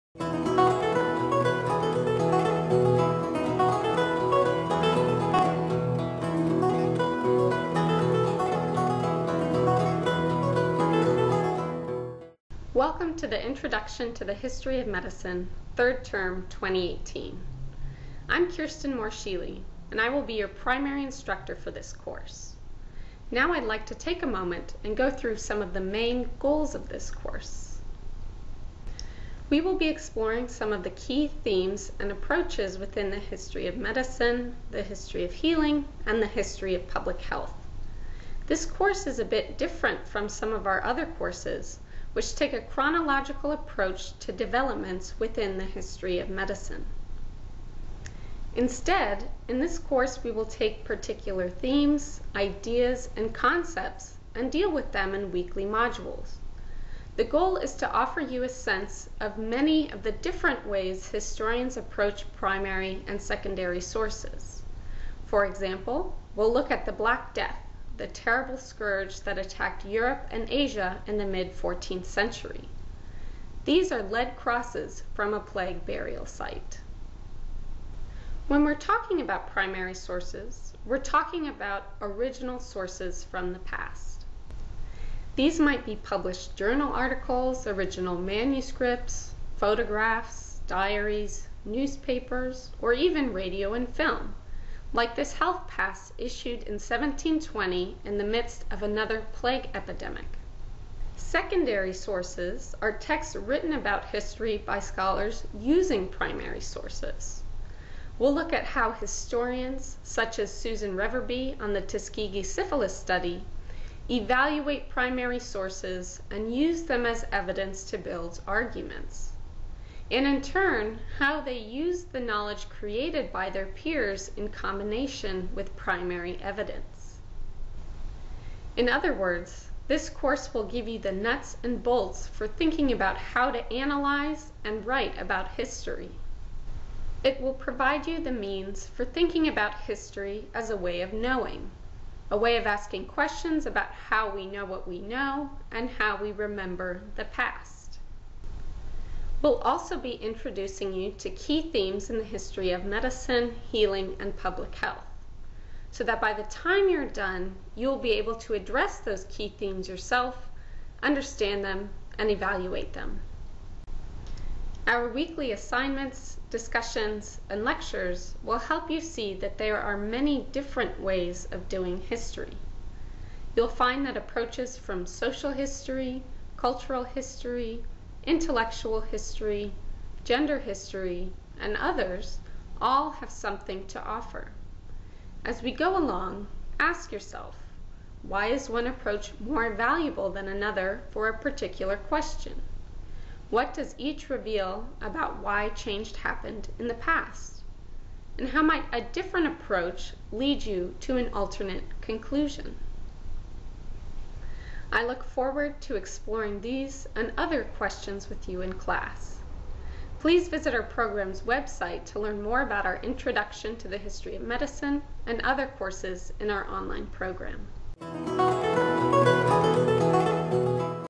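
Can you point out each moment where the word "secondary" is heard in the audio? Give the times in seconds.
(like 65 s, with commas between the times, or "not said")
63 s, 101 s.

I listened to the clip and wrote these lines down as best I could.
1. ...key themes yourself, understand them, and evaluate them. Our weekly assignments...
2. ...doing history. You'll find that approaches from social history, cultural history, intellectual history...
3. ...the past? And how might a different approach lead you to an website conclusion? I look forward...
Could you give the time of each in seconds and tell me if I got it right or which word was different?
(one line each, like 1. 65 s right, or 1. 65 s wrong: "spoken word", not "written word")
1. 159 s right
2. 171 s right
3. 196 s wrong: "alternate", not "website".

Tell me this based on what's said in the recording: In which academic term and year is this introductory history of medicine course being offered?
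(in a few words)
Third Term 2018.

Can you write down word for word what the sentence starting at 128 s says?
In other words, this course will give you the nuts and bolts for thinking about how to analyze and write about history.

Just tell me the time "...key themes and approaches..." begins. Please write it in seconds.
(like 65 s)
30 s.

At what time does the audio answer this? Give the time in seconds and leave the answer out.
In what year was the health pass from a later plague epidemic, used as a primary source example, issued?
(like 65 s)
96 s.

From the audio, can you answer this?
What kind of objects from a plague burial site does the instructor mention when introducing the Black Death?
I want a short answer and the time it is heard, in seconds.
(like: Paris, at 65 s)
Lead crosses, at 74 s.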